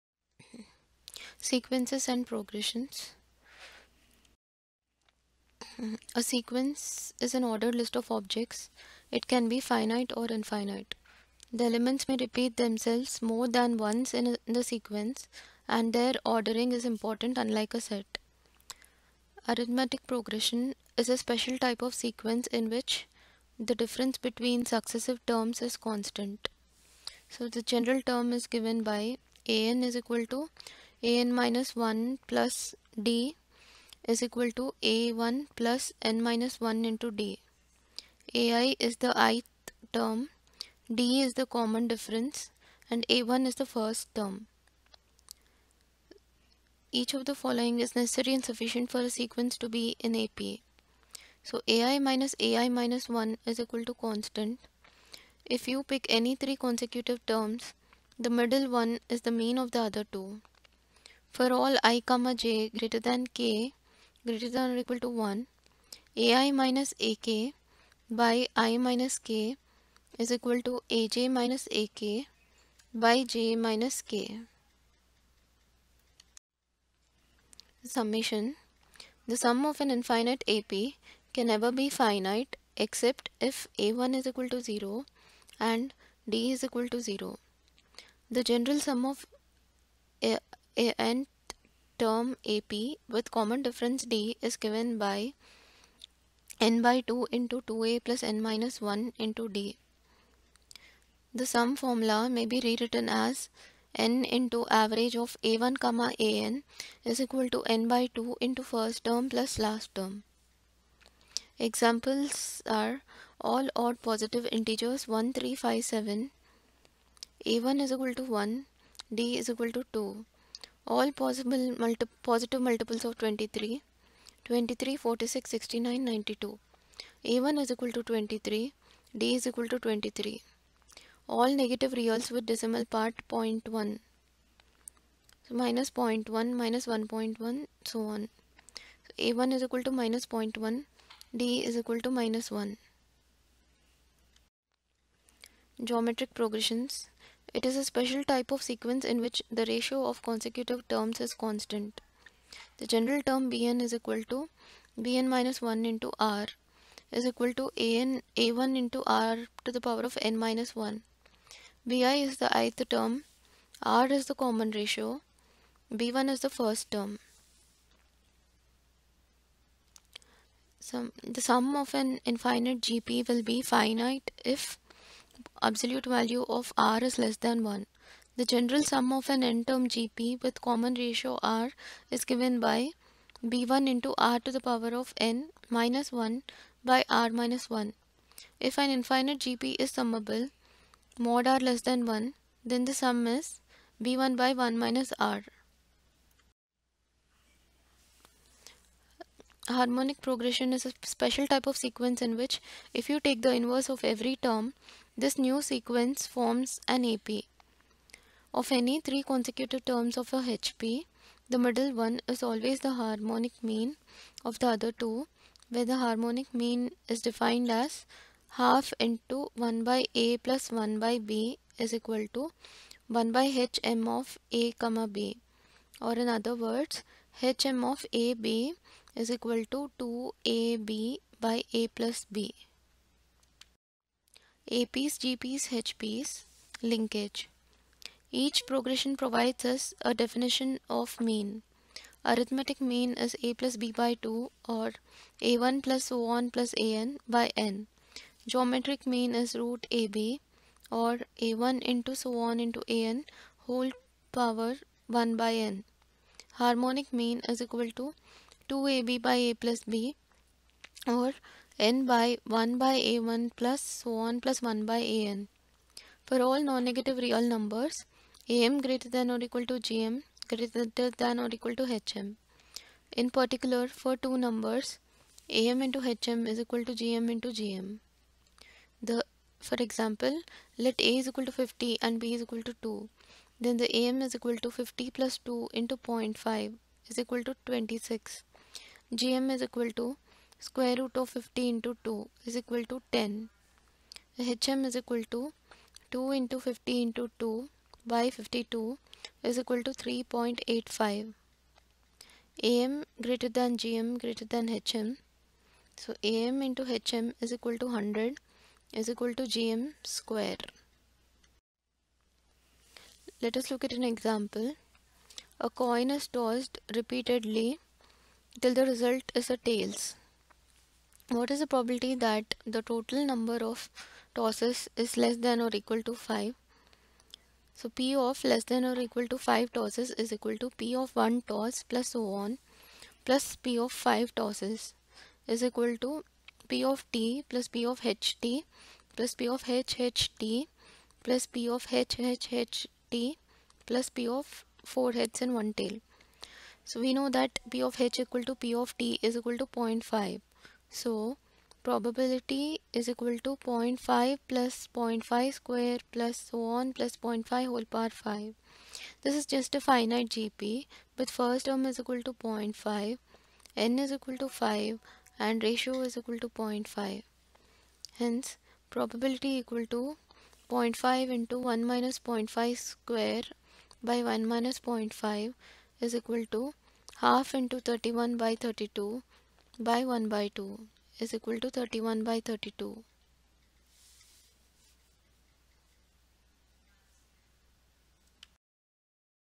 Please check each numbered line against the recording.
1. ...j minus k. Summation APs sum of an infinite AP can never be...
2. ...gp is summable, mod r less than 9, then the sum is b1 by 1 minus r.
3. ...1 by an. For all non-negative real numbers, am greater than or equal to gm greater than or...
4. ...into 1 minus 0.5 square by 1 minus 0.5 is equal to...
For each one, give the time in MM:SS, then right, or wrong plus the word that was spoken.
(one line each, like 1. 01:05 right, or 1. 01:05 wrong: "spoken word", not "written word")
1. 01:13 wrong: "The", not "APs"
2. 03:09 wrong: "1", not "9"
3. 04:24 right
4. 06:11 right.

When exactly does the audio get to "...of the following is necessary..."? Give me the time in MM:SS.
00:47.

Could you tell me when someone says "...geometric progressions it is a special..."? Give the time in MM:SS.
02:25.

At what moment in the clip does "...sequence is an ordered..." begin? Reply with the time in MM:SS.
00:06.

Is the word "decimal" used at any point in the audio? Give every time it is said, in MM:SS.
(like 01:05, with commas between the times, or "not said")
02:12.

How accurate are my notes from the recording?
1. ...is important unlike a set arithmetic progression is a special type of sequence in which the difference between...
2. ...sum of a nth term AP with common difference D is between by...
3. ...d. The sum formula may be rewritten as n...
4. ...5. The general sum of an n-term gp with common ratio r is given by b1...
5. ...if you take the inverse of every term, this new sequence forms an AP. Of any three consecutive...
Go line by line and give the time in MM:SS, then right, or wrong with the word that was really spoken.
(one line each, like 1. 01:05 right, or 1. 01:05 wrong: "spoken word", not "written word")
1. 00:16 right
2. 01:28 wrong: "given", not "between"
3. 01:39 right
4. 02:57 wrong: "1", not "5"
5. 03:22 right.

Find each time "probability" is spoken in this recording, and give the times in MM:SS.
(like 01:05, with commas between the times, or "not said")
05:21, 05:51, 06:08.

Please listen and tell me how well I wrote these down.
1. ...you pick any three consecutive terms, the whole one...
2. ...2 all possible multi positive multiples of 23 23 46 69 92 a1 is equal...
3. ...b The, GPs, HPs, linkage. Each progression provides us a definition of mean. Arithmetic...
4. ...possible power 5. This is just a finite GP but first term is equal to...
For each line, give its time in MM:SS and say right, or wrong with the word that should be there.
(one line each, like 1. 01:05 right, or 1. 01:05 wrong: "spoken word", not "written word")
1. 00:55 wrong: "middle", not "whole"
2. 01:59 right
3. 03:52 wrong: "APs", not "The"
4. 05:57 wrong: "whole", not "possible".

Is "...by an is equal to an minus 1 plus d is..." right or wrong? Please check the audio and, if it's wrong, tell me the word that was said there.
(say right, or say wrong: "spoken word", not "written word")
right.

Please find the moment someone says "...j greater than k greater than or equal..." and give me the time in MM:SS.
01:02.